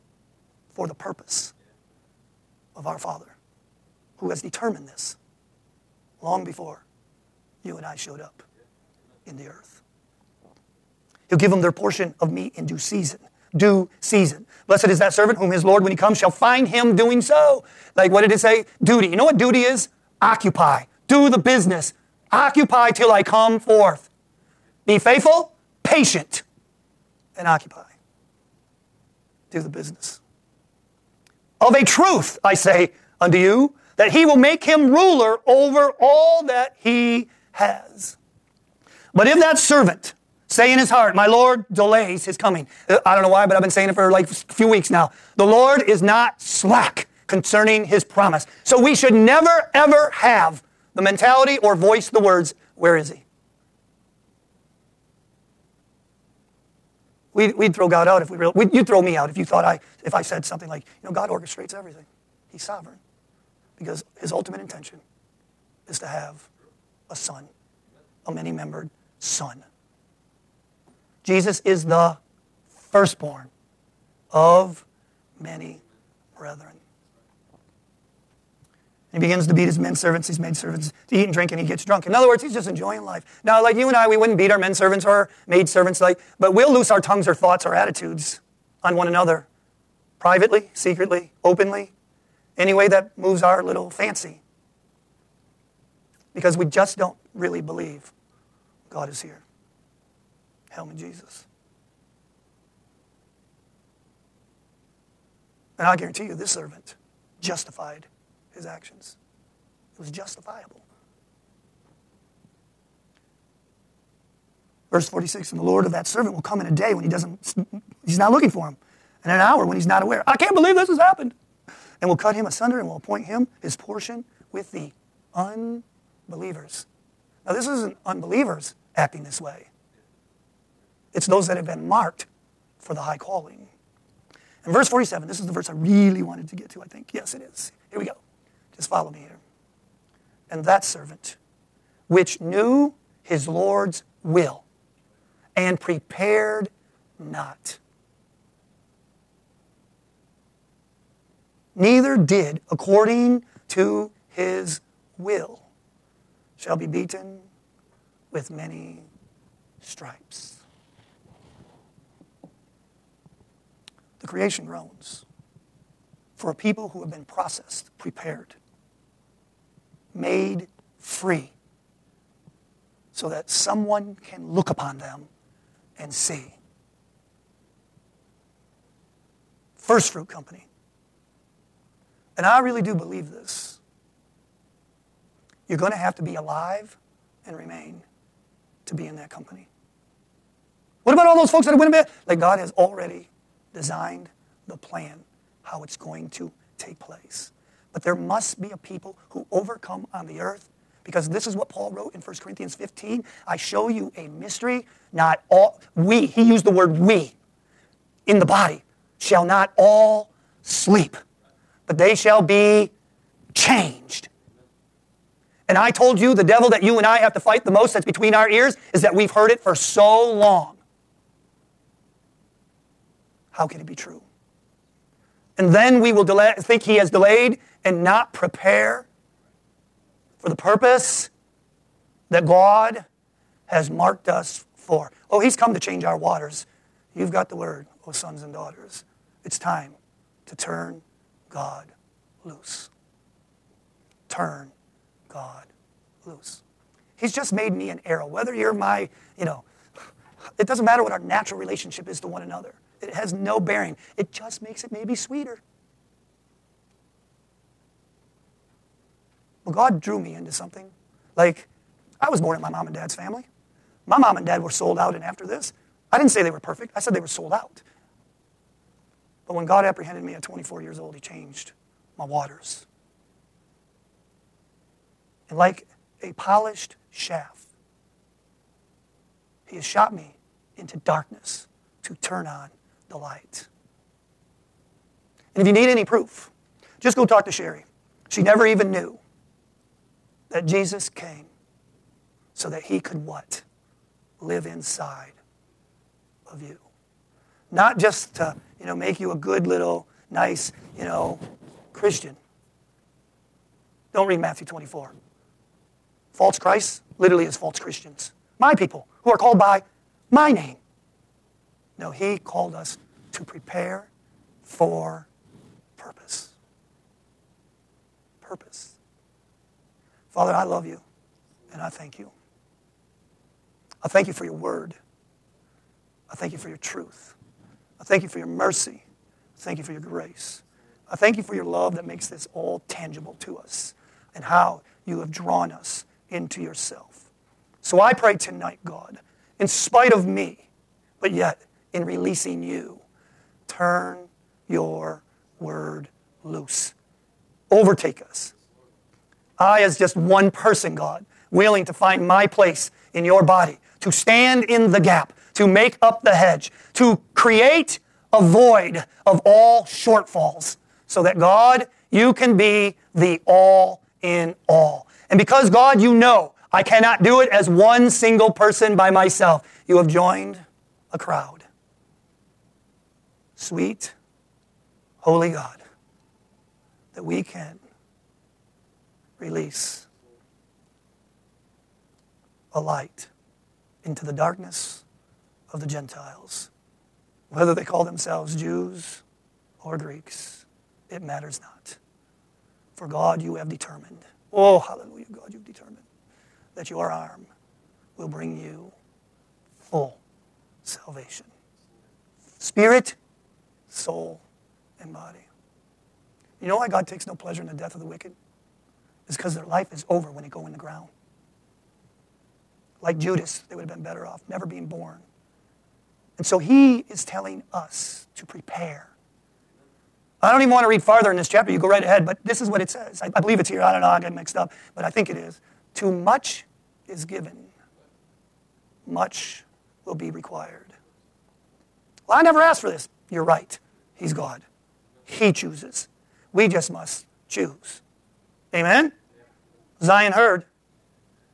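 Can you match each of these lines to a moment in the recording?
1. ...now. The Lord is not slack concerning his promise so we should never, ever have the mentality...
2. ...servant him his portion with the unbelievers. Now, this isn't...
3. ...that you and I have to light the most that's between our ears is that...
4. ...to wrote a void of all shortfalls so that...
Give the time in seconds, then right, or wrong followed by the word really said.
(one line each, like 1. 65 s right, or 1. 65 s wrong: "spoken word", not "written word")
1. 44 s right
2. 122 s wrong: "appoint", not "servant"
3. 216 s wrong: "fight", not "light"
4. 356 s wrong: "create", not "wrote".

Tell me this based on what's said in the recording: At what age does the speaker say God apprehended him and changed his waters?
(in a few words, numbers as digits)
24.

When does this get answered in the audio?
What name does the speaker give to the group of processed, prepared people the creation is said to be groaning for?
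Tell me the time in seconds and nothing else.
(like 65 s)
179 s.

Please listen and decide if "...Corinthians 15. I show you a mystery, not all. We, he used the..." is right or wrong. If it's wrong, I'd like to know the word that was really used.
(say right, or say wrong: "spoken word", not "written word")
right.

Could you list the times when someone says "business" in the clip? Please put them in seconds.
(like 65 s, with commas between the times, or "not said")
21 s, 29 s.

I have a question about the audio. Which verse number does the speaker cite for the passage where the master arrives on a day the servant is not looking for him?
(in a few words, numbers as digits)
46.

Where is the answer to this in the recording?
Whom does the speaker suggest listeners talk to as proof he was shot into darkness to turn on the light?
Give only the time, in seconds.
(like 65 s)
287 s.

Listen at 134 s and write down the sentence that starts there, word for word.
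And verse 47, this is the verse I really wanted to get to, I think.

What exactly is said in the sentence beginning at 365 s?
And because God, you know, I cannot do it as one single person by myself.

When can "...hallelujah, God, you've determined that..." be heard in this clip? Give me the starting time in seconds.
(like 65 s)
394 s.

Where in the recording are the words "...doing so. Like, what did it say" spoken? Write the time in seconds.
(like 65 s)
16 s.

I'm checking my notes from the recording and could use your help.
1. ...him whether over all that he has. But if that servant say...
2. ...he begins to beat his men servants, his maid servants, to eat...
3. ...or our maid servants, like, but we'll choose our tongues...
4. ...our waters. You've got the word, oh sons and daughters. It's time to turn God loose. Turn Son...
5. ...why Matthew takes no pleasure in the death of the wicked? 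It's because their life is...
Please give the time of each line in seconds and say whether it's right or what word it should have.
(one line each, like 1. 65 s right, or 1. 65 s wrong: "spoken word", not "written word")
1. 34 s wrong: "ruler", not "whether"
2. 79 s right
3. 85 s wrong: "loose", not "choose"
4. 236 s wrong: "God", not "Son"
5. 406 s wrong: "God", not "Matthew".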